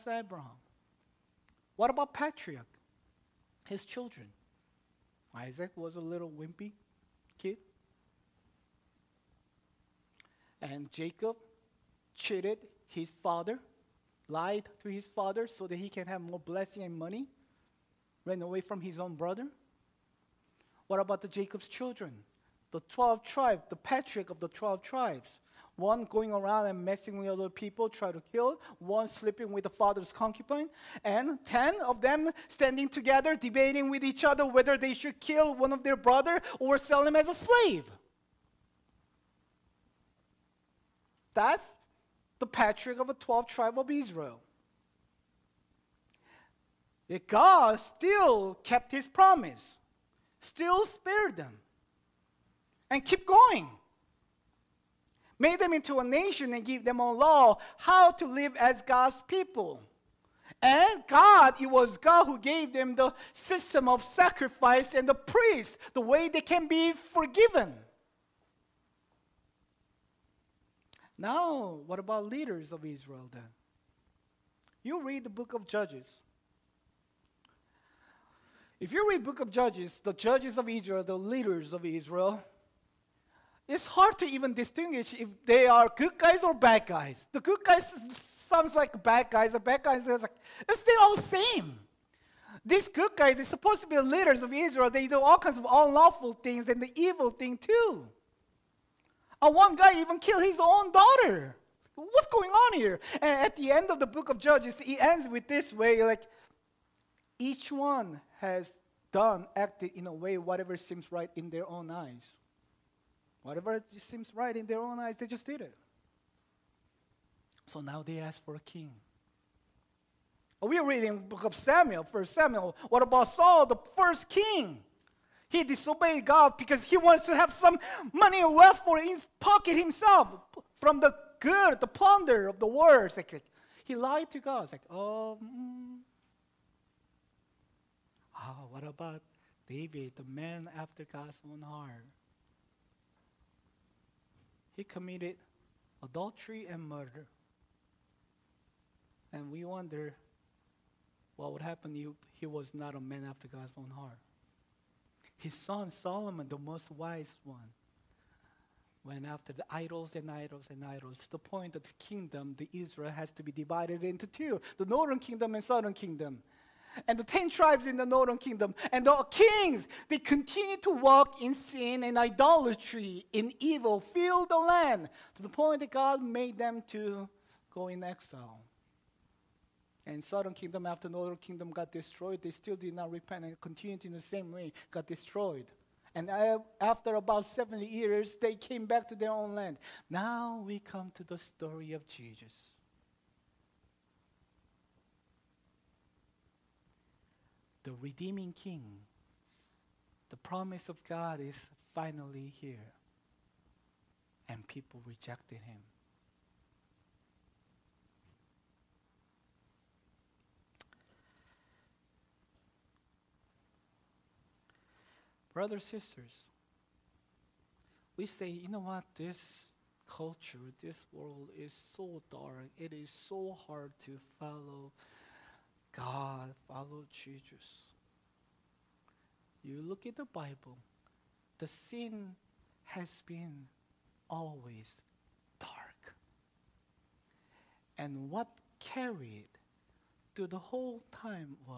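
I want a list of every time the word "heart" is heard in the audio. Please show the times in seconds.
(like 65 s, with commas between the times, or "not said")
141 s, 153 s.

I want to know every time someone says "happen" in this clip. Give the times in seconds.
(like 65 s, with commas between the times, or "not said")
151 s.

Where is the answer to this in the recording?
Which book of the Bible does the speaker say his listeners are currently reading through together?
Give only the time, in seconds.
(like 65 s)
122 s.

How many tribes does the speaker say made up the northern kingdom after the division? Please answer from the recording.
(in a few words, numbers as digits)
10.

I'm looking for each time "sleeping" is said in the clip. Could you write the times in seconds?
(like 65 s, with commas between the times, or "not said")
29 s.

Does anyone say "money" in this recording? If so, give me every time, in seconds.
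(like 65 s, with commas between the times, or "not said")
16 s, 128 s.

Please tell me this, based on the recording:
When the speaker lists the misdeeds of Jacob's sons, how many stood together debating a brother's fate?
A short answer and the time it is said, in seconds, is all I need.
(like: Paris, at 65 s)
10, at 31 s.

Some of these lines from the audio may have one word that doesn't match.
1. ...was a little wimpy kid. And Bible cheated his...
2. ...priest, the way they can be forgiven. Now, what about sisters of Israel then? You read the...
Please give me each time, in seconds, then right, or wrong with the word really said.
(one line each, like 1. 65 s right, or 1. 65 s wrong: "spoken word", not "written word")
1. 5 s wrong: "Jacob", not "Bible"
2. 65 s wrong: "leaders", not "sisters".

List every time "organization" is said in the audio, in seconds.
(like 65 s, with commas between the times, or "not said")
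not said.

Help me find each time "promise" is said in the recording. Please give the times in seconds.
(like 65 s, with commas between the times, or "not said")
49 s, 200 s.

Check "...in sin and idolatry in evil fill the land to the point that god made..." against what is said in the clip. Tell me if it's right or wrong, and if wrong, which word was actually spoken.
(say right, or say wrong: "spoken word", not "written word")
right.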